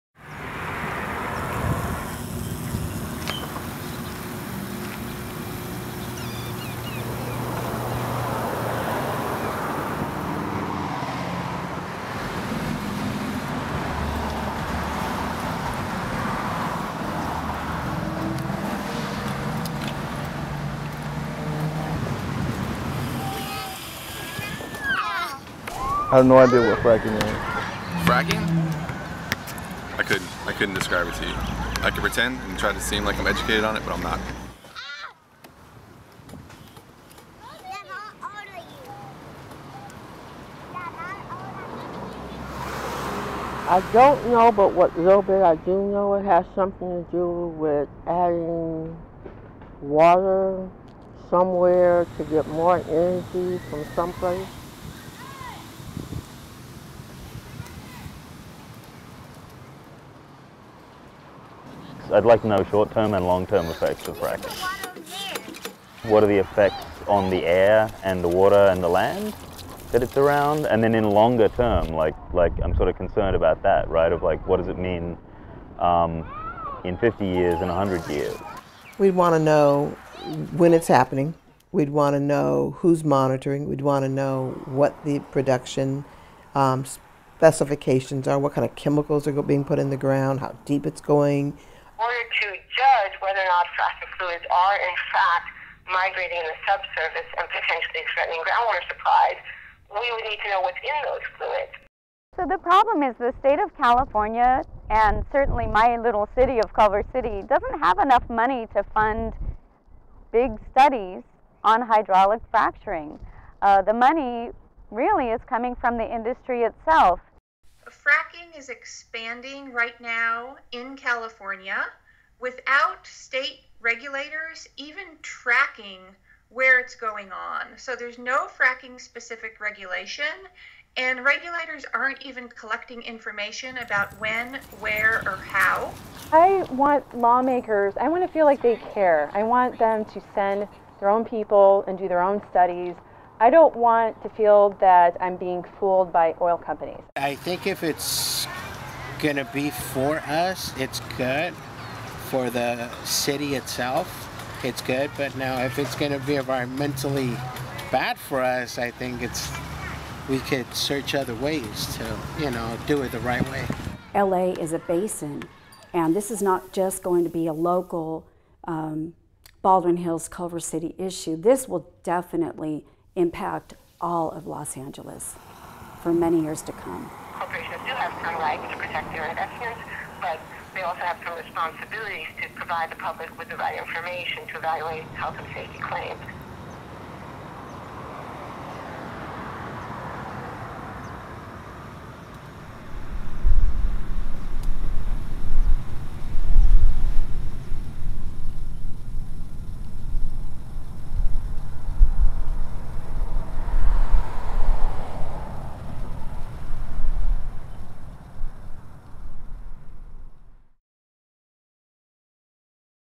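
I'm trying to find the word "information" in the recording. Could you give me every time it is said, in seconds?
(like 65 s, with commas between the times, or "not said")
133 s, 183 s.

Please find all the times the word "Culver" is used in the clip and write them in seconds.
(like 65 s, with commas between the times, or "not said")
106 s, 170 s.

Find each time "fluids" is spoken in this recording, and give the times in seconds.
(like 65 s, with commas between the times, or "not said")
94 s, 101 s.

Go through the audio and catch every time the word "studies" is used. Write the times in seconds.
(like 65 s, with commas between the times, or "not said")
110 s, 142 s.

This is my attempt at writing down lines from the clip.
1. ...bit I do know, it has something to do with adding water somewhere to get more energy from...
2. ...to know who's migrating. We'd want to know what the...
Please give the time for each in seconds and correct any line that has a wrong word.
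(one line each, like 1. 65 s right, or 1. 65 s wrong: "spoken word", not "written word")
1. 45 s right
2. 82 s wrong: "monitoring", not "migrating".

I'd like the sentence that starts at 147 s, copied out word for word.
I think if it's going to be for us, it's good for the city itself, it's good.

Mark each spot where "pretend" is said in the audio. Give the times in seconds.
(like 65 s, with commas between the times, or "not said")
32 s.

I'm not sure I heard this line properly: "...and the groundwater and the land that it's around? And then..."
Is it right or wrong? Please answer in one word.
wrong.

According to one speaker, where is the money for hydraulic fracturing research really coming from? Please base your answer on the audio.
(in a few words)
the industry itself.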